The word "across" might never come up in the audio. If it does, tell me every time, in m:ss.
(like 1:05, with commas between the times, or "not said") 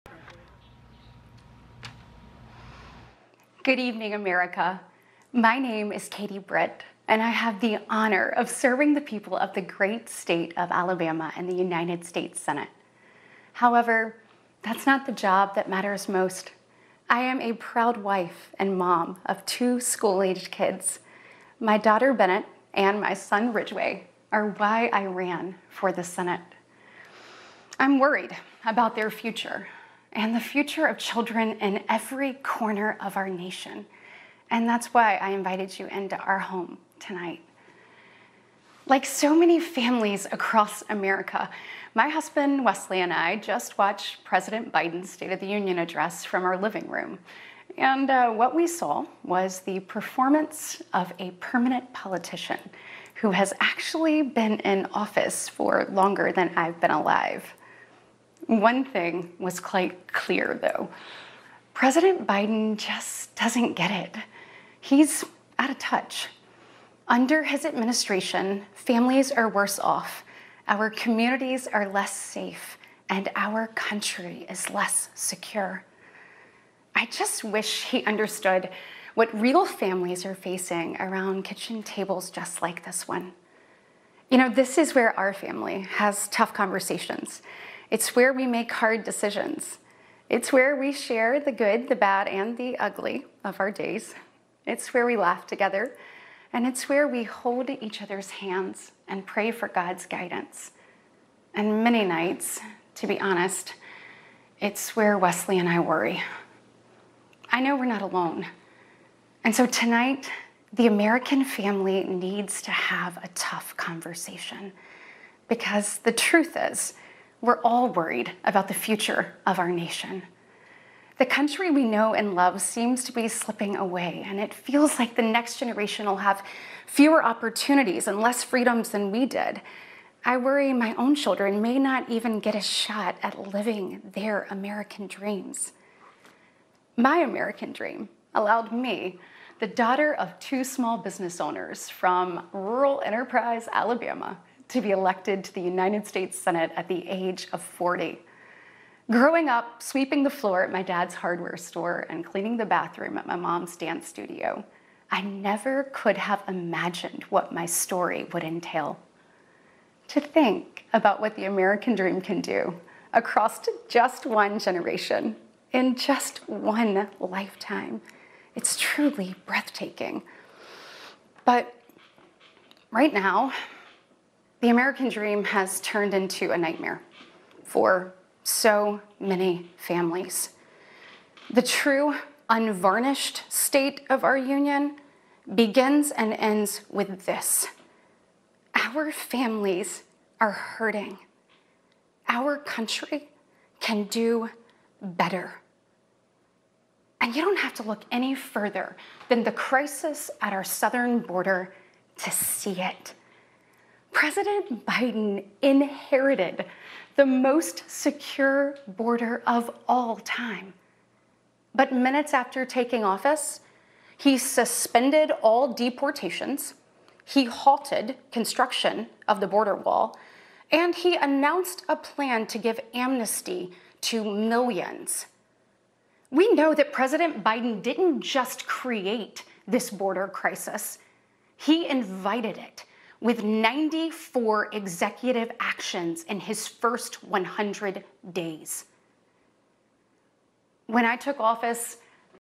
0:40, 2:43.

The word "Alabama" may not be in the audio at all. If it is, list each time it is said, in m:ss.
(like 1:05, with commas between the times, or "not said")
0:10, 2:23.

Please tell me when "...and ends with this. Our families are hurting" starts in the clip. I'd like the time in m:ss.
3:06.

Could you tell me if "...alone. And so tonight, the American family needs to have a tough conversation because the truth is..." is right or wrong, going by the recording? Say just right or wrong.
right.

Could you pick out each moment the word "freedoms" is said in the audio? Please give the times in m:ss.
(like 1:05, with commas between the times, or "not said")
2:08.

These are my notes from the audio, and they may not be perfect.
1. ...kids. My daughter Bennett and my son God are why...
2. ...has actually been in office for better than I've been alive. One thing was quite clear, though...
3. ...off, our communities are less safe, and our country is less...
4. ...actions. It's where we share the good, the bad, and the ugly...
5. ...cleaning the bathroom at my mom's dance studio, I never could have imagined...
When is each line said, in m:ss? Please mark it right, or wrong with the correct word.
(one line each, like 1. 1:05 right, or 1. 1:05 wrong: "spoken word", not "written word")
1. 0:20 wrong: "Ridgeway", not "God"
2. 0:53 wrong: "longer", not "better"
3. 1:09 right
4. 1:29 wrong: "decisions", not "actions"
5. 2:32 right.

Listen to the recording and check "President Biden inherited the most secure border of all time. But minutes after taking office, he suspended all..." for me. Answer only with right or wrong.
right.